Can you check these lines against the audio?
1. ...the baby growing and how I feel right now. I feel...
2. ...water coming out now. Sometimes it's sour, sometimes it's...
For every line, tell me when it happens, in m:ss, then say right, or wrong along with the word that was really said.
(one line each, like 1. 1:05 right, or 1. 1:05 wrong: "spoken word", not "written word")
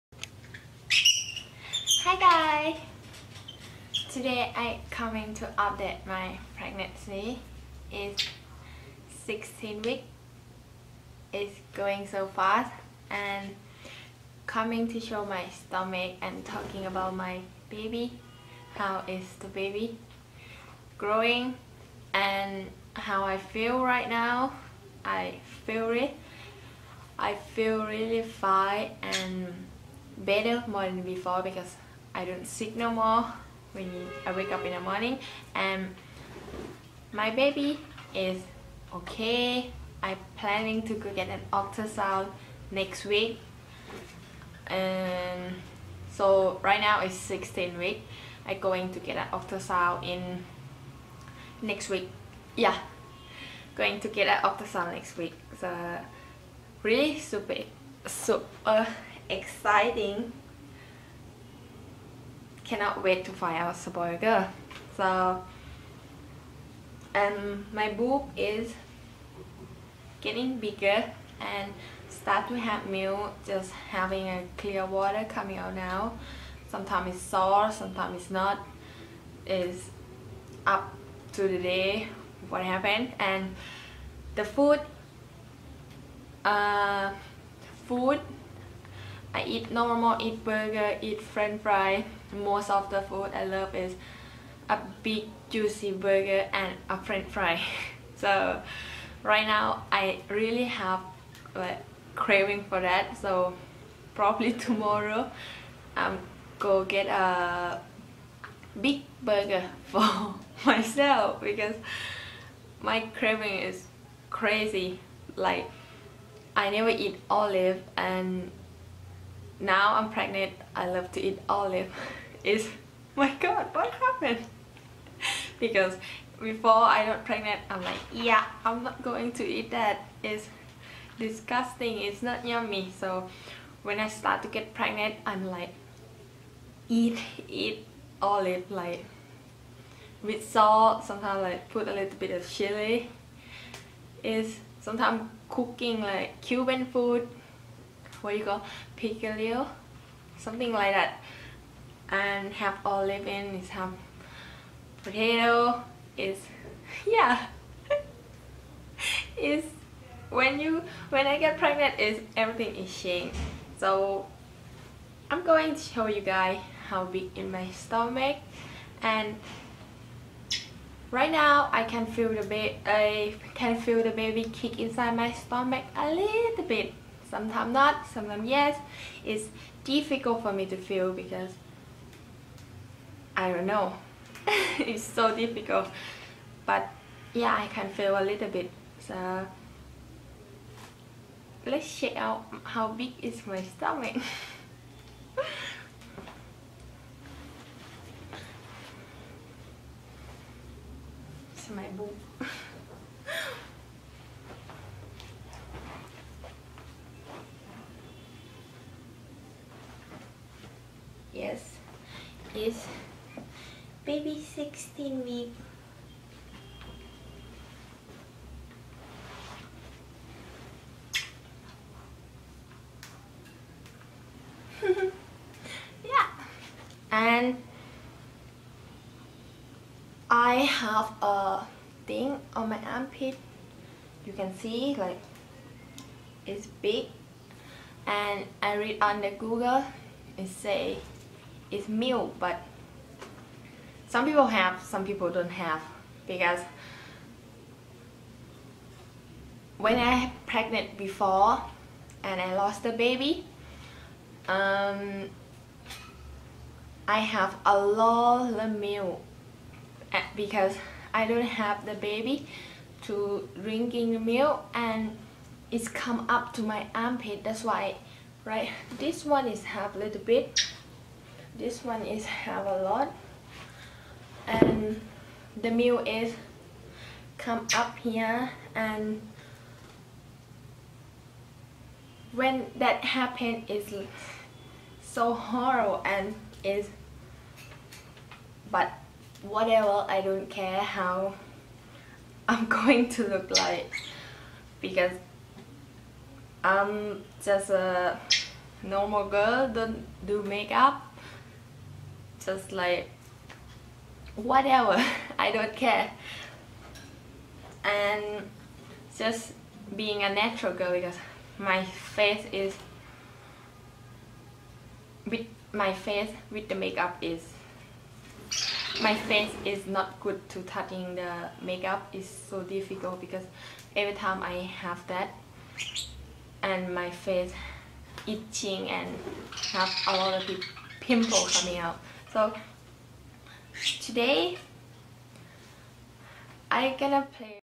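1. 0:19 right
2. 1:14 right.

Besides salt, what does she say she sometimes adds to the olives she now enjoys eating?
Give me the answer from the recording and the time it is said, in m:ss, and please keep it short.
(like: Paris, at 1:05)
chili, at 2:22.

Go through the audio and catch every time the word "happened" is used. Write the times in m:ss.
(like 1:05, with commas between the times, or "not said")
1:22, 2:03, 4:43.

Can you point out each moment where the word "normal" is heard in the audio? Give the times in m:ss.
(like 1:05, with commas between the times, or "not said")
1:29, 4:58.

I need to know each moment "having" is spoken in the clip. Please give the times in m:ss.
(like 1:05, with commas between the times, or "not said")
1:13.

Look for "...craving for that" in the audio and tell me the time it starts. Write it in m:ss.
1:42.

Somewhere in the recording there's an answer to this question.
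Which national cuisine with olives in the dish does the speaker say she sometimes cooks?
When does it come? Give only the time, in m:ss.
2:26.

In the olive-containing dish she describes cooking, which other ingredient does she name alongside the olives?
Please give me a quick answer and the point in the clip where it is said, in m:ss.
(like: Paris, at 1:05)
potato, at 2:35.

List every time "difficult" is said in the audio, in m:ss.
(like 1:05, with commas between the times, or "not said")
2:59, 3:05, 5:22.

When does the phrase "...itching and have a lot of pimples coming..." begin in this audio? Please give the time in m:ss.
5:28.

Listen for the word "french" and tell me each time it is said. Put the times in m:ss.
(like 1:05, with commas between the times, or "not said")
1:31, 1:36.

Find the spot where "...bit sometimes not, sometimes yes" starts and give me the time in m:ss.
2:56.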